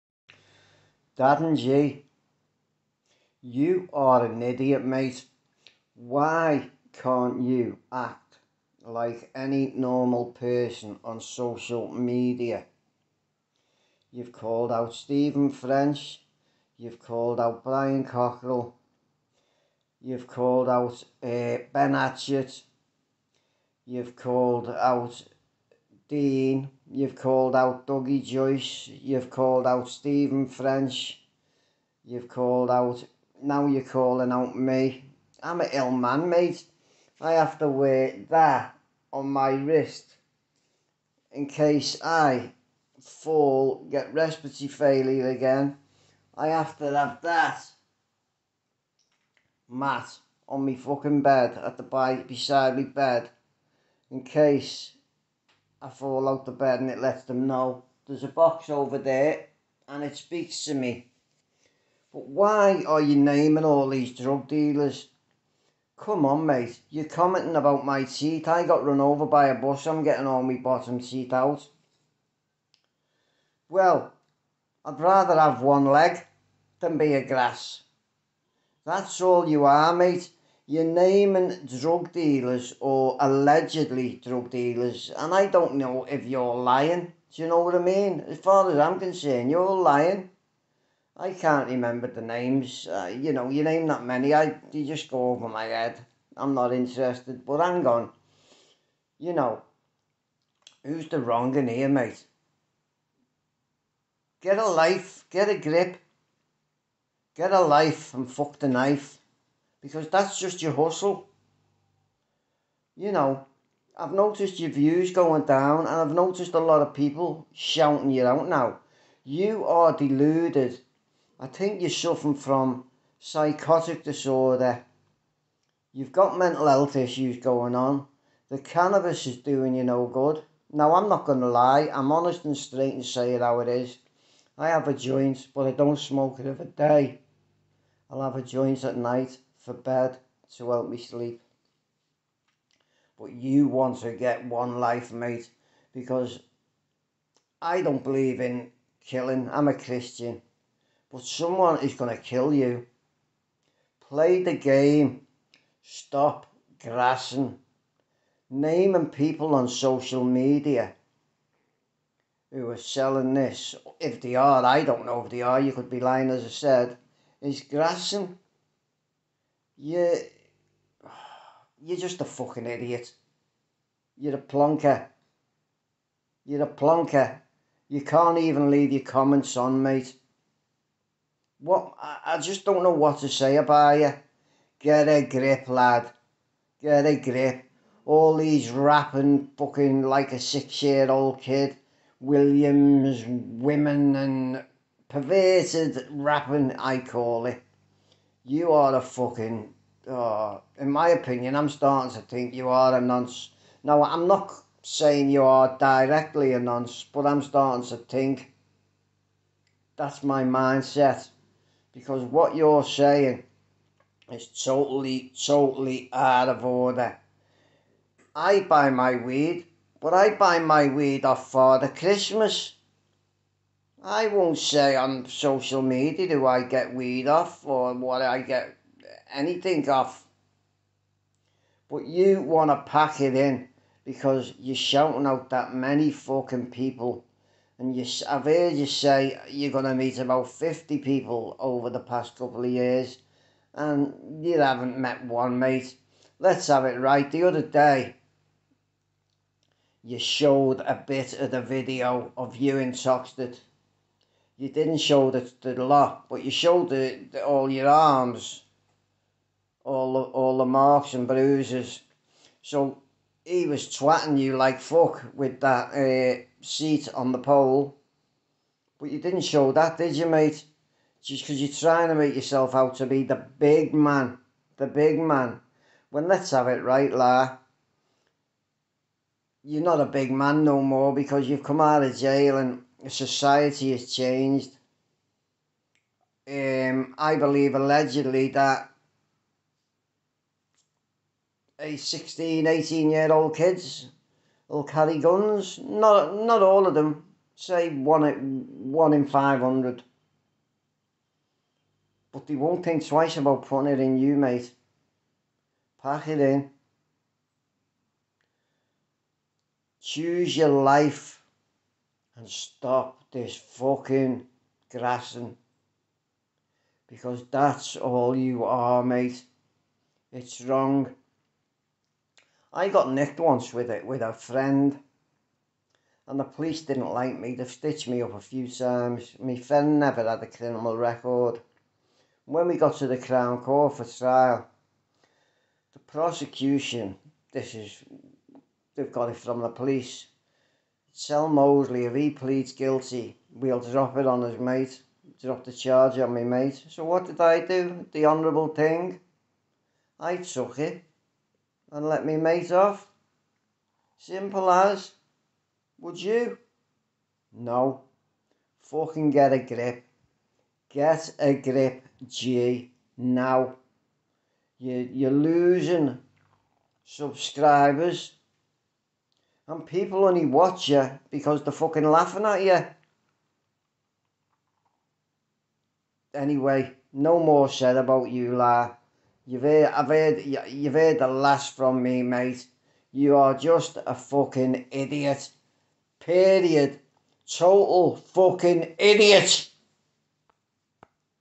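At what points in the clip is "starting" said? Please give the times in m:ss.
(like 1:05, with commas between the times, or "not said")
3:21, 3:27.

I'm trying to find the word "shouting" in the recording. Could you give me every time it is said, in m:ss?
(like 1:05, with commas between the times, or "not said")
1:57, 3:54.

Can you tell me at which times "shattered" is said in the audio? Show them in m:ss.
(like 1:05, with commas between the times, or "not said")
not said.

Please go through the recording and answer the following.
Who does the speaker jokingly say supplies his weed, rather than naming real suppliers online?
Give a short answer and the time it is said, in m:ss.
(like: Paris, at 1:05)
Father Christmas, at 3:41.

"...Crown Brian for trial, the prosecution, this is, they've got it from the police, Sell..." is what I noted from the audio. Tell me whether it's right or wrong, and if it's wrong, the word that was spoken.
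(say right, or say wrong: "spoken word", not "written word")
wrong: "Court", not "Brian".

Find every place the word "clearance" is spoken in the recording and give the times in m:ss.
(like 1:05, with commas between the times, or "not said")
not said.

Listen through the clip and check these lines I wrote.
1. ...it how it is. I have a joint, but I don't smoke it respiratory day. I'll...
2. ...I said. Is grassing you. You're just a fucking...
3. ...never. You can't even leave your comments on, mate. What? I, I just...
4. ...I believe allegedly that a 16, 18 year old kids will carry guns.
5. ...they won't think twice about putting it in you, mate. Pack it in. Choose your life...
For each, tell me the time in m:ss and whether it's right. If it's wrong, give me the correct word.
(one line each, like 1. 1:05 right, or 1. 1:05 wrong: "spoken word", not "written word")
1. 2:13 wrong: "every", not "respiratory"
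2. 2:46 right
3. 2:56 wrong: "plonker", not "never"
4. 4:47 right
5. 5:02 right.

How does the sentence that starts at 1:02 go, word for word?
But why are you naming all these drug dealers?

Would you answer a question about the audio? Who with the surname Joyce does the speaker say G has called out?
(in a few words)
Dougie Joyce.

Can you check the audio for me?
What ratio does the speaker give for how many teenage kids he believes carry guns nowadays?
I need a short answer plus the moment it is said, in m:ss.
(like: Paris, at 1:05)
1 in 500, at 4:58.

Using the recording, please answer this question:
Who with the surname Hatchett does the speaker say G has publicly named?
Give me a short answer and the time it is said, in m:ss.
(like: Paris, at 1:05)
Ben Hatchett, at 0:21.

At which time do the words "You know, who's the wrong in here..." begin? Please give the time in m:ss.
1:39.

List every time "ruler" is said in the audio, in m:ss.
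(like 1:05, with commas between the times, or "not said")
not said.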